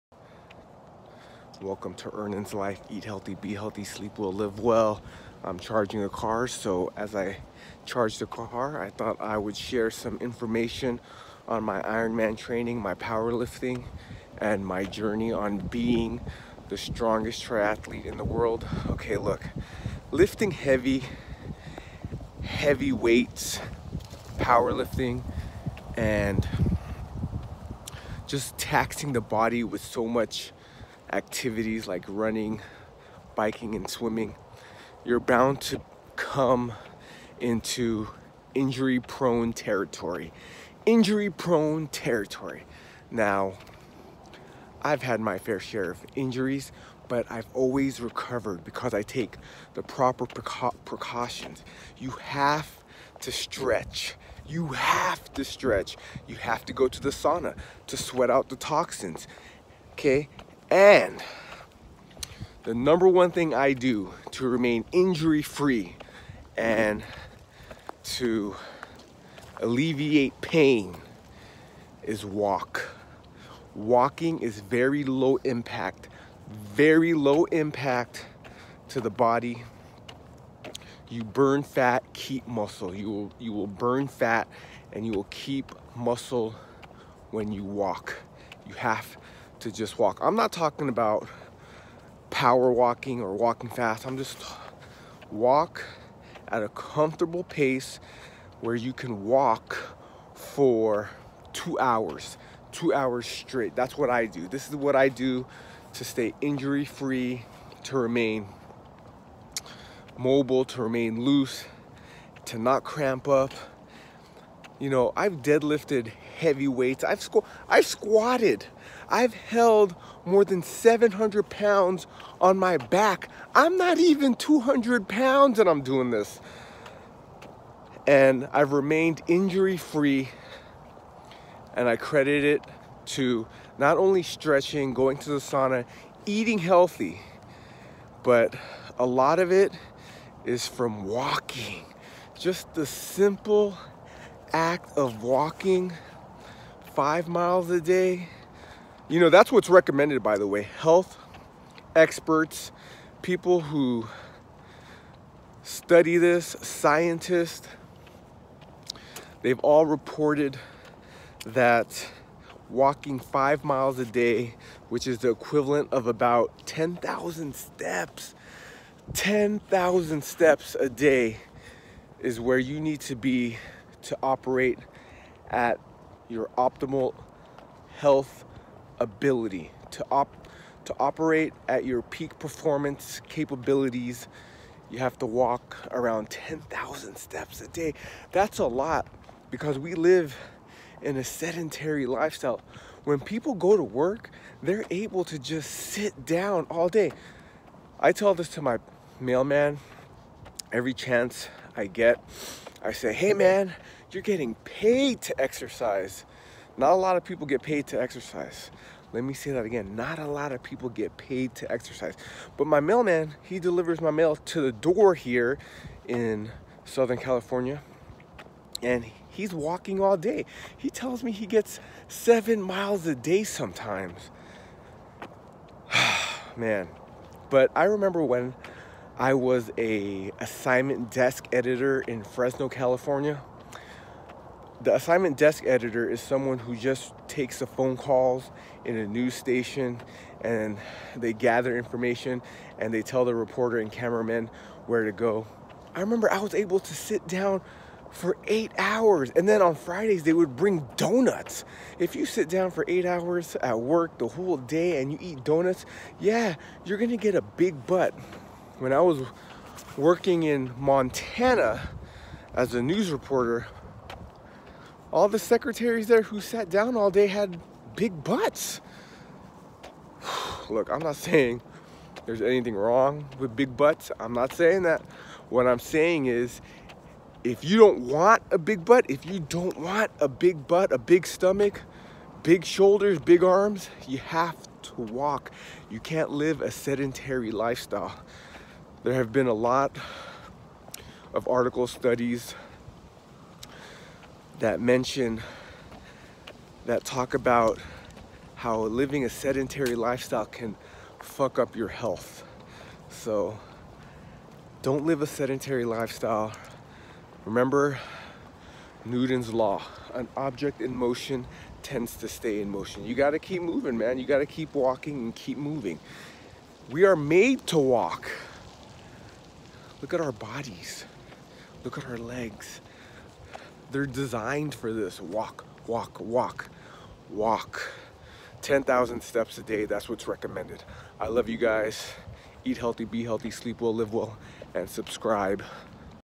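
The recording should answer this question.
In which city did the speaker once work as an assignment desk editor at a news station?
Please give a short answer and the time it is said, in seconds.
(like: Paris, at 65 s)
Fresno, at 232 s.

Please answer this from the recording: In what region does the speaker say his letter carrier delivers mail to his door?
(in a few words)
Southern California.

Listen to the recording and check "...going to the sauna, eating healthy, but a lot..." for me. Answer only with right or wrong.
right.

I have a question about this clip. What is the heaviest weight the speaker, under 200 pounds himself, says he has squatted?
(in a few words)
700 pounds.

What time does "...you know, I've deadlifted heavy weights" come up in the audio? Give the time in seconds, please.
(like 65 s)
114 s.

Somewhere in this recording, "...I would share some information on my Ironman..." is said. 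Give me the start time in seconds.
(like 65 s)
9 s.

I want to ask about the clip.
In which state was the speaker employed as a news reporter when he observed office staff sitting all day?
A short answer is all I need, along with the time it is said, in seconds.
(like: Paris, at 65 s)
Montana, at 260 s.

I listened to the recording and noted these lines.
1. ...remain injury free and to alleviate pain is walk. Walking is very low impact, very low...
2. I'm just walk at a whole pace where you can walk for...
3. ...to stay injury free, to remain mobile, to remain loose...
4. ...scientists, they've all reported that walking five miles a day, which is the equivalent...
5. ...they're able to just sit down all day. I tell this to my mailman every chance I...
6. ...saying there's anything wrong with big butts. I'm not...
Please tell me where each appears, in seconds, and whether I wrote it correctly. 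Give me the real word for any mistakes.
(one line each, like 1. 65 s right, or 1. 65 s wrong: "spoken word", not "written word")
1. 64 s right
2. 94 s wrong: "comfortable", not "whole"
3. 105 s right
4. 156 s right
5. 194 s right
6. 271 s right.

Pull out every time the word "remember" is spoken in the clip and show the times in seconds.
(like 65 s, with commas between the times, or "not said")
227 s, 245 s, 307 s.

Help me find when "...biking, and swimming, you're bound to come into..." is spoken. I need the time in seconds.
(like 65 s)
33 s.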